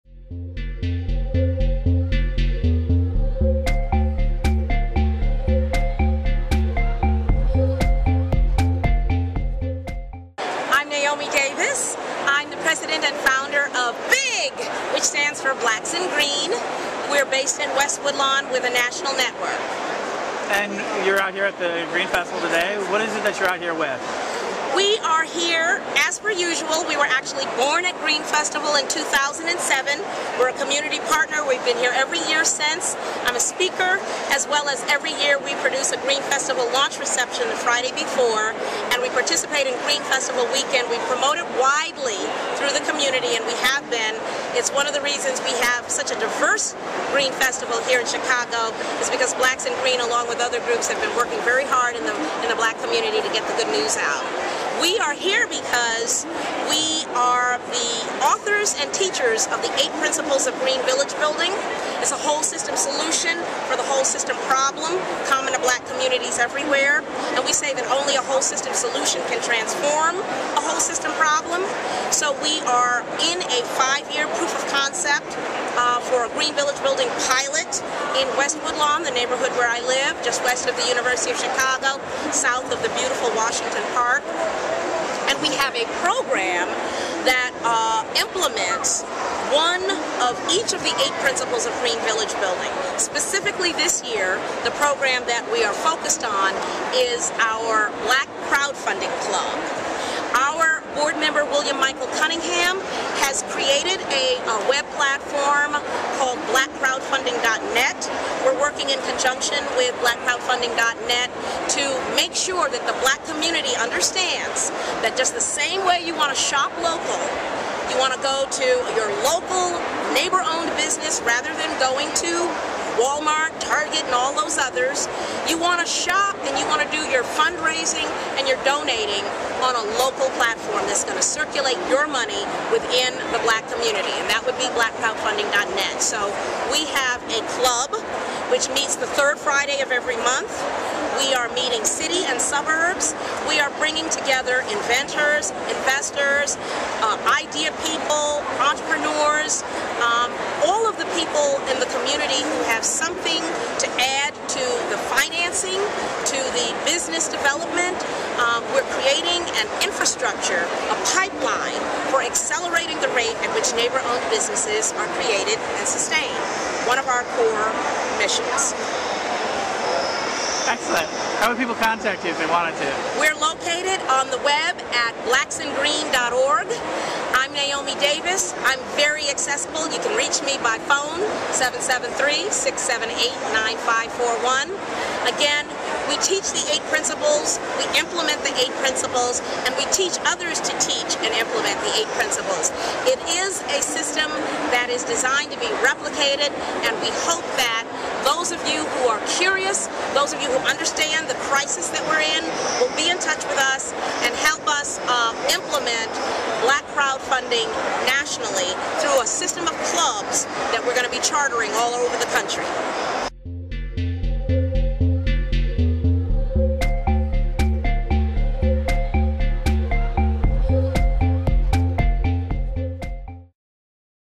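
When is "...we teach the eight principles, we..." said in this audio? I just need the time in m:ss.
3:06.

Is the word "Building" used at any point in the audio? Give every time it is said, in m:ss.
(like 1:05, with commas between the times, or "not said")
1:01, 1:16, 1:32.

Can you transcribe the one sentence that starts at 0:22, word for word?
What is it that you're out here with?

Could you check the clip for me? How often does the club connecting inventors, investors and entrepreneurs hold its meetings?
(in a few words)
Third Friday of every month.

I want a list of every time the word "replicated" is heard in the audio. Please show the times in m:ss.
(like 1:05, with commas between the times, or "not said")
3:15.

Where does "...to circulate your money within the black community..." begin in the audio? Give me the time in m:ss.
2:11.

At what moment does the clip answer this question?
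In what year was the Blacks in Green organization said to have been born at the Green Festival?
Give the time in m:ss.
0:28.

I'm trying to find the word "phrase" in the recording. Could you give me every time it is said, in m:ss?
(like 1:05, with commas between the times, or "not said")
not said.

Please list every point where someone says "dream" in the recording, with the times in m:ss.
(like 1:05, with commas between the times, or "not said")
not said.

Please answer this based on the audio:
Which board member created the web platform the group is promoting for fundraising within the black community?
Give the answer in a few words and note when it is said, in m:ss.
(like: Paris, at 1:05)
William Michael Cunningham, at 1:41.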